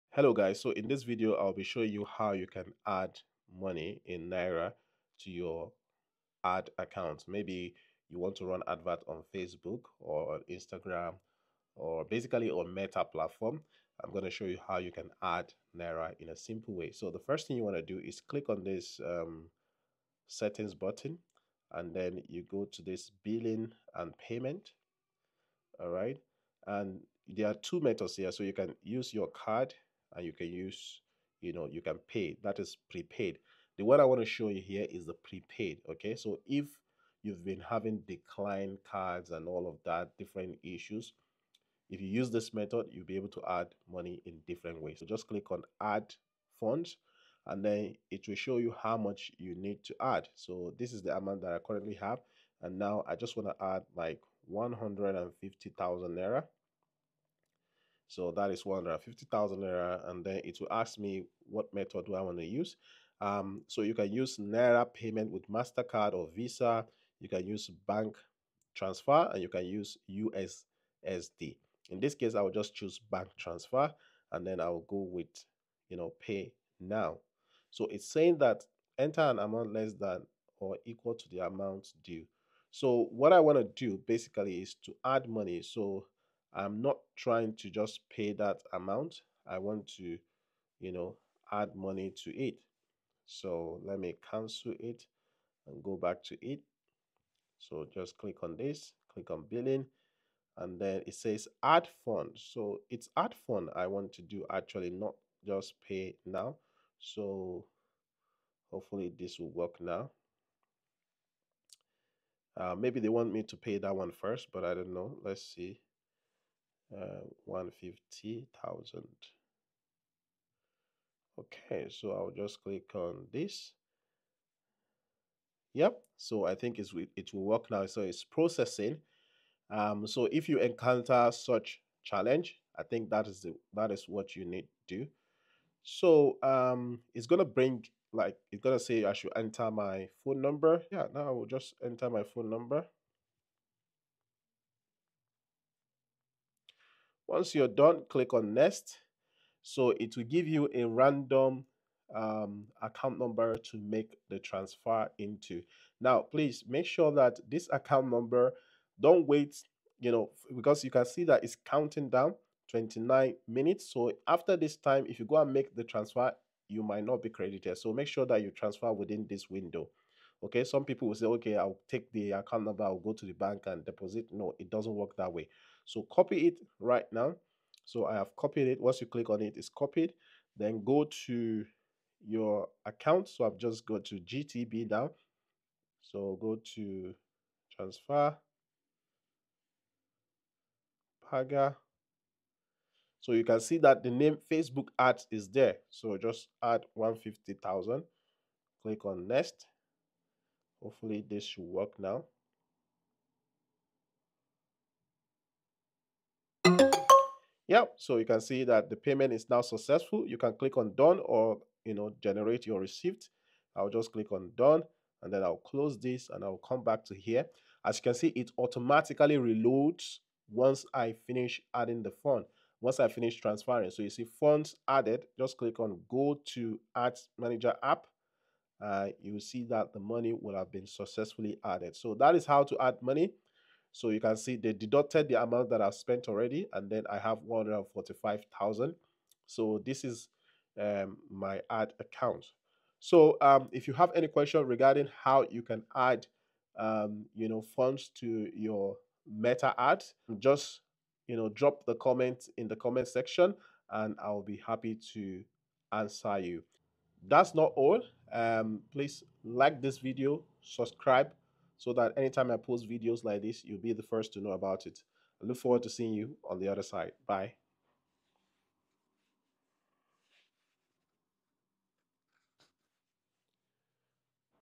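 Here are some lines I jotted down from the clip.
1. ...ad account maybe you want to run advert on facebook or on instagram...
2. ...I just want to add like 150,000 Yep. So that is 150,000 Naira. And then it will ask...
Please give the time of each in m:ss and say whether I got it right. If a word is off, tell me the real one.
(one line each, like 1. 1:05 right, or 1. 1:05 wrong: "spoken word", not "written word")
1. 0:06 right
2. 0:53 wrong: "Naira", not "Yep".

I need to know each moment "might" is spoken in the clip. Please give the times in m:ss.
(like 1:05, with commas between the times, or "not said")
2:46.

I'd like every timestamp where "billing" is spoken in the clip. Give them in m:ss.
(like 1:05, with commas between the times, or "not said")
0:23, 1:39.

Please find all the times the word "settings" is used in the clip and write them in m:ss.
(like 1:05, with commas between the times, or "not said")
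0:20.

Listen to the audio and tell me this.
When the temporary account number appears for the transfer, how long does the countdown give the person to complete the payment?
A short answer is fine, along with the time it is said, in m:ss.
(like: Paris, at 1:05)
29 minutes, at 2:42.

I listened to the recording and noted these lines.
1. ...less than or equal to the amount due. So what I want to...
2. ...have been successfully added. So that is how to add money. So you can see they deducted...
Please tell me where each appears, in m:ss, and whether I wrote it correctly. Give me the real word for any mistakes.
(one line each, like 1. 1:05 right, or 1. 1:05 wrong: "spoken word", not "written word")
1. 1:19 right
2. 3:50 right.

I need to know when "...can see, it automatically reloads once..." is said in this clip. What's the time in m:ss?
3:38.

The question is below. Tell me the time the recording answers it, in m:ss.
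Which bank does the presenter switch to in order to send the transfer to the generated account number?
3:04.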